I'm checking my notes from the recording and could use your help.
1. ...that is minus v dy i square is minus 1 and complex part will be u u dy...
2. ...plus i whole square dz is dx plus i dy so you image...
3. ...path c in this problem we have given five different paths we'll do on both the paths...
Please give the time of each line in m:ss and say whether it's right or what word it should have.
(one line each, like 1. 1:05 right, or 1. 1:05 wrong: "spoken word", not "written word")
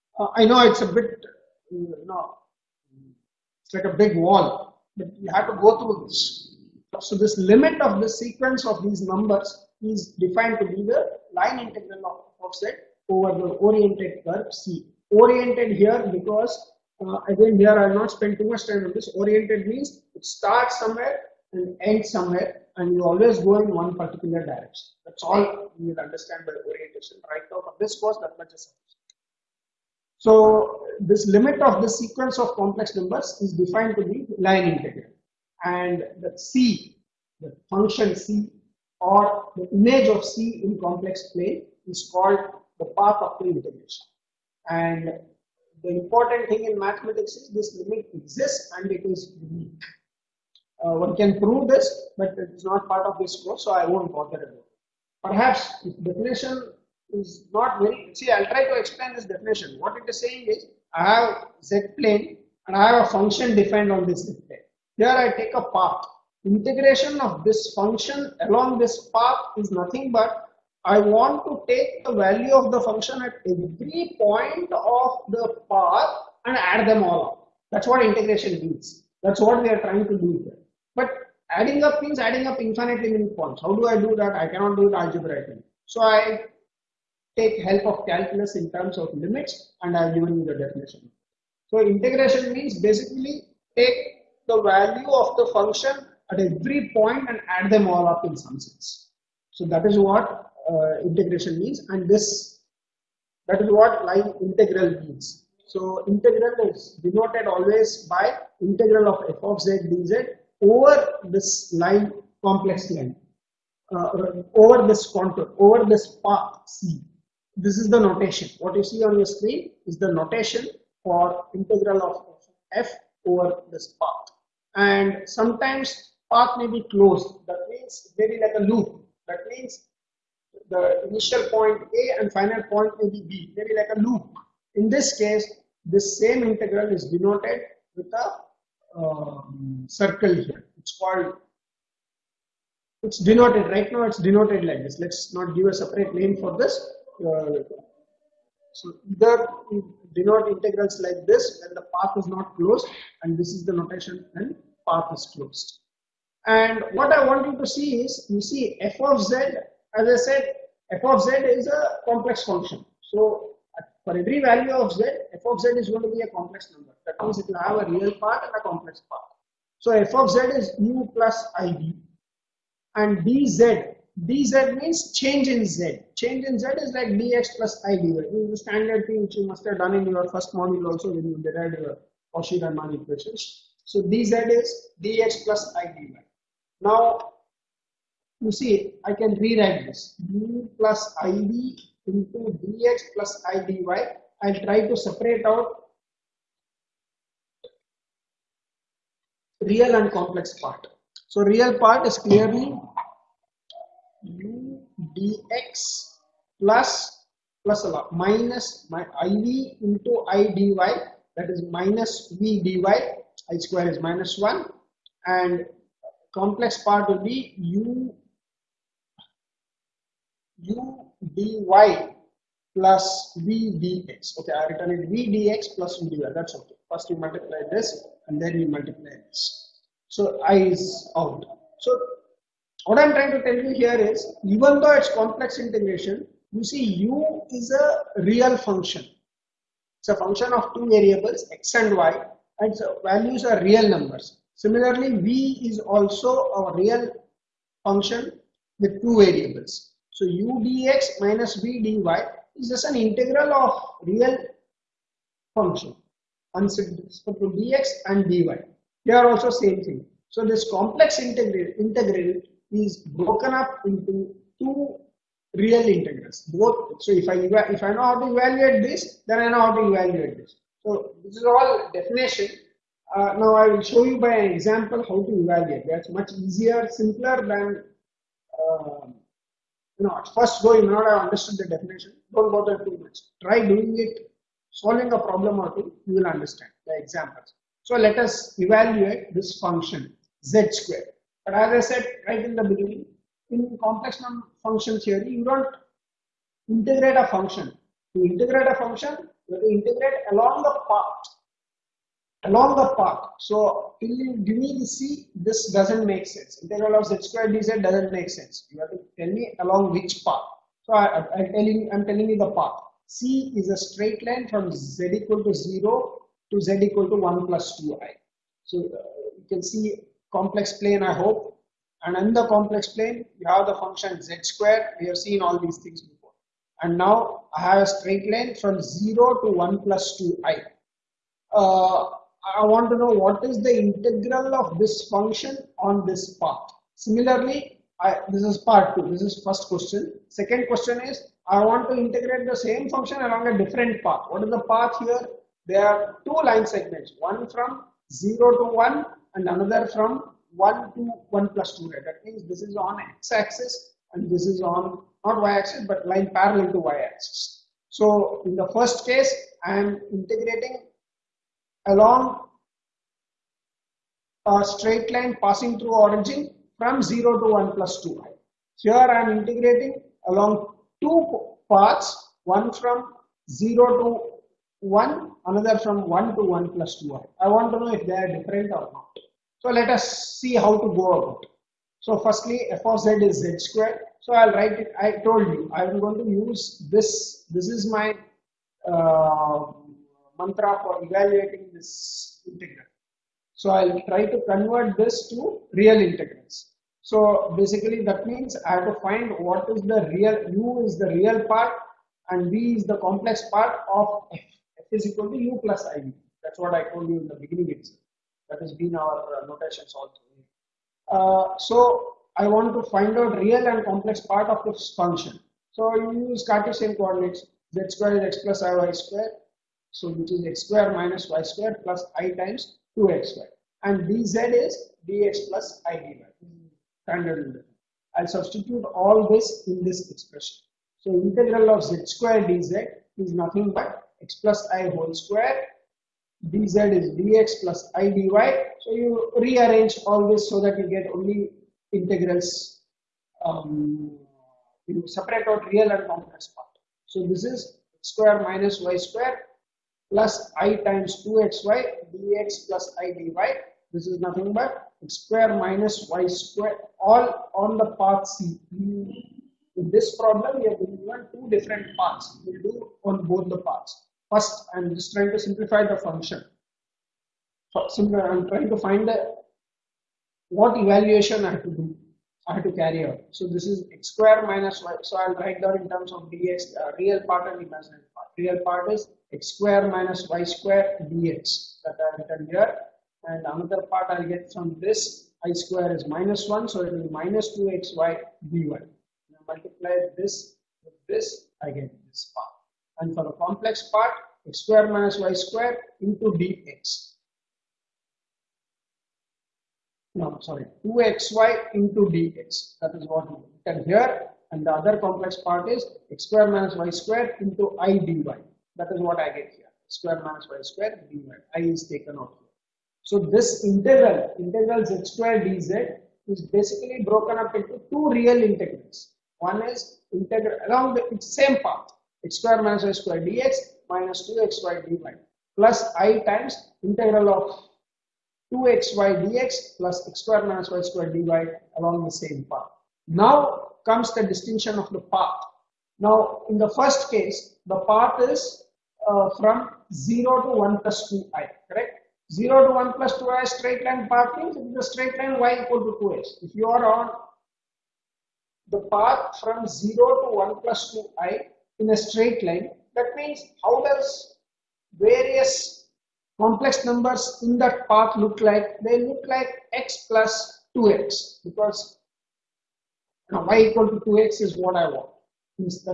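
1. 3:31 right
2. 7:14 wrong: "rearrange", not "image"
3. 7:38 wrong: "two", not "five".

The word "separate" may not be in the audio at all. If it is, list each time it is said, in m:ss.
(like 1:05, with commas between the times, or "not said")
2:25, 3:14, 7:25.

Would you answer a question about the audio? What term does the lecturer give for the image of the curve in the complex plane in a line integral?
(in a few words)
path of the integration.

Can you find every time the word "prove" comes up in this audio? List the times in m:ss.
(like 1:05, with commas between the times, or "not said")
0:51.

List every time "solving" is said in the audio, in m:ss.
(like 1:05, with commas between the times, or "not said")
4:44.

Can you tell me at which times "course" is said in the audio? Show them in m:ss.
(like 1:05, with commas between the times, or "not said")
0:27, 0:53.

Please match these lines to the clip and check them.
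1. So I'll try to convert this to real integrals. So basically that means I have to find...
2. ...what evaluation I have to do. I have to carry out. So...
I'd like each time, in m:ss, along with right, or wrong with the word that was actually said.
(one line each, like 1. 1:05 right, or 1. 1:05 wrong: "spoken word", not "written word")
1. 6:33 right
2. 7:50 right.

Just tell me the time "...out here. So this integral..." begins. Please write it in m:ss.
8:32.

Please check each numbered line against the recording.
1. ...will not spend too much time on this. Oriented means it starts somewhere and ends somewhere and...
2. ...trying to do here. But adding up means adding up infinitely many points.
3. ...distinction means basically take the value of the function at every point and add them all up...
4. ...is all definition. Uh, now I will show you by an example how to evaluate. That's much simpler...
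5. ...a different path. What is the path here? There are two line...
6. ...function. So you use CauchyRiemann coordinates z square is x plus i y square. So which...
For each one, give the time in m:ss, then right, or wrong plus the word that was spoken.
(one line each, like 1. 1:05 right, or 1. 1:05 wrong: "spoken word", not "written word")
1. 0:17 right
2. 1:19 right
3. 1:31 wrong: "integration", not "distinction"
4. 4:31 wrong: "easier", not "simpler"
5. 5:43 right
6. 6:54 wrong: "Cartesian", not "CauchyRiemann".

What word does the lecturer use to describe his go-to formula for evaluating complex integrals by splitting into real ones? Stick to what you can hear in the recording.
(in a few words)
mantra.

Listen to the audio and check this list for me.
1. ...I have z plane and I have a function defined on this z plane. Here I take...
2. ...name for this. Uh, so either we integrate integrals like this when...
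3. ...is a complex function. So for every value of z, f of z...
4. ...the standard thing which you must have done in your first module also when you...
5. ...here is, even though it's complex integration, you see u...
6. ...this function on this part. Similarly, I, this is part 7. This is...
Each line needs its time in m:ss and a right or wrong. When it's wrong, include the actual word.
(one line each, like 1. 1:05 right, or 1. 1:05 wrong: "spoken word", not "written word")
1. 1:00 right
2. 2:26 wrong: "denote", not "integrate"
3. 2:41 right
4. 2:58 right
5. 3:53 right
6. 5:34 wrong: "2", not "7".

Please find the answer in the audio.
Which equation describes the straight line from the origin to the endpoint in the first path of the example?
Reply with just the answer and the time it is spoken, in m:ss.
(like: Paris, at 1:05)
y = 2x, at 9:05.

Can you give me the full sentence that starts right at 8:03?
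And another part I'll get from this i square is minus 1, so it will be minus 2xy dy.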